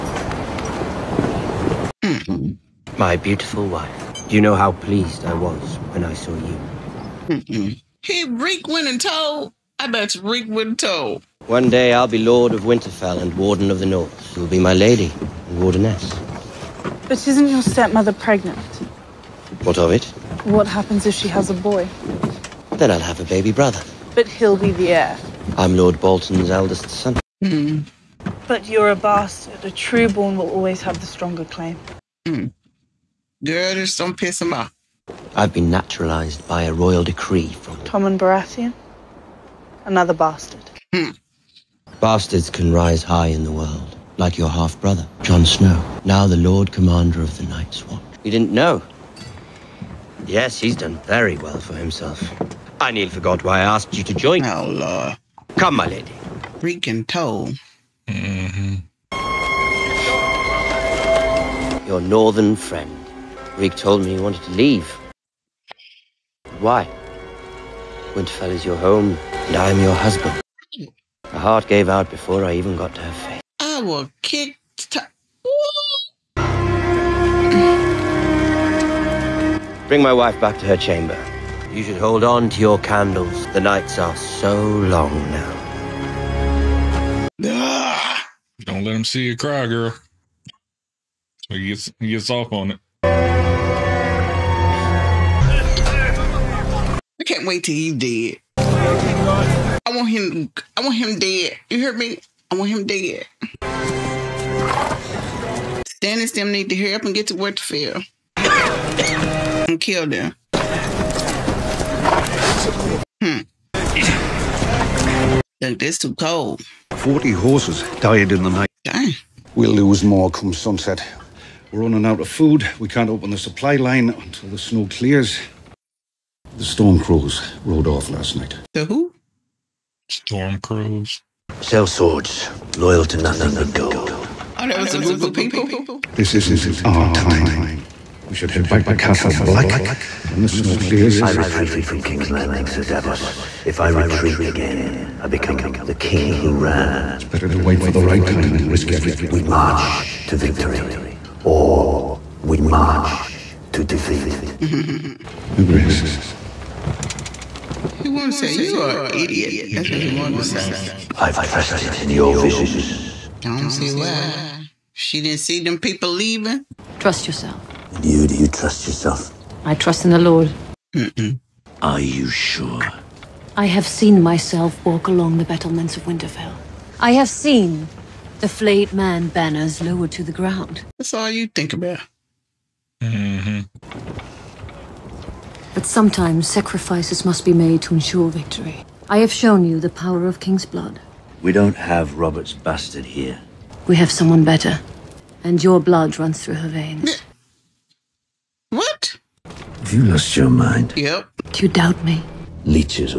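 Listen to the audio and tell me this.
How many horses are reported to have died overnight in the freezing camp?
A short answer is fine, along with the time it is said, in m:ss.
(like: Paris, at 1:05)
40, at 1:56.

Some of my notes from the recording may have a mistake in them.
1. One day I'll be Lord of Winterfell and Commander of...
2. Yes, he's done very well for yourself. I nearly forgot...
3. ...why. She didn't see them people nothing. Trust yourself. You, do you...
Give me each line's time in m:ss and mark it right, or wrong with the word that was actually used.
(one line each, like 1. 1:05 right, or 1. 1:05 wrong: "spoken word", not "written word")
1. 0:11 wrong: "Warden", not "Commander"
2. 0:50 wrong: "himself", not "yourself"
3. 2:43 wrong: "leaving", not "nothing".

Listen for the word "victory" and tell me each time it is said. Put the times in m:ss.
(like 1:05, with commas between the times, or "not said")
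2:30, 3:08.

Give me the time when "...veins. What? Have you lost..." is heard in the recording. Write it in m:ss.
3:16.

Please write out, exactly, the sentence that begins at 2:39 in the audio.
That's yeah, what he wanted to say.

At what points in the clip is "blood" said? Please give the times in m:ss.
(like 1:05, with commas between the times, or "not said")
3:10, 3:15.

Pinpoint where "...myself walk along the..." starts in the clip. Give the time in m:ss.
2:54.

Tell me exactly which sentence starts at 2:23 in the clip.
If I retreat again, I become the king who ran.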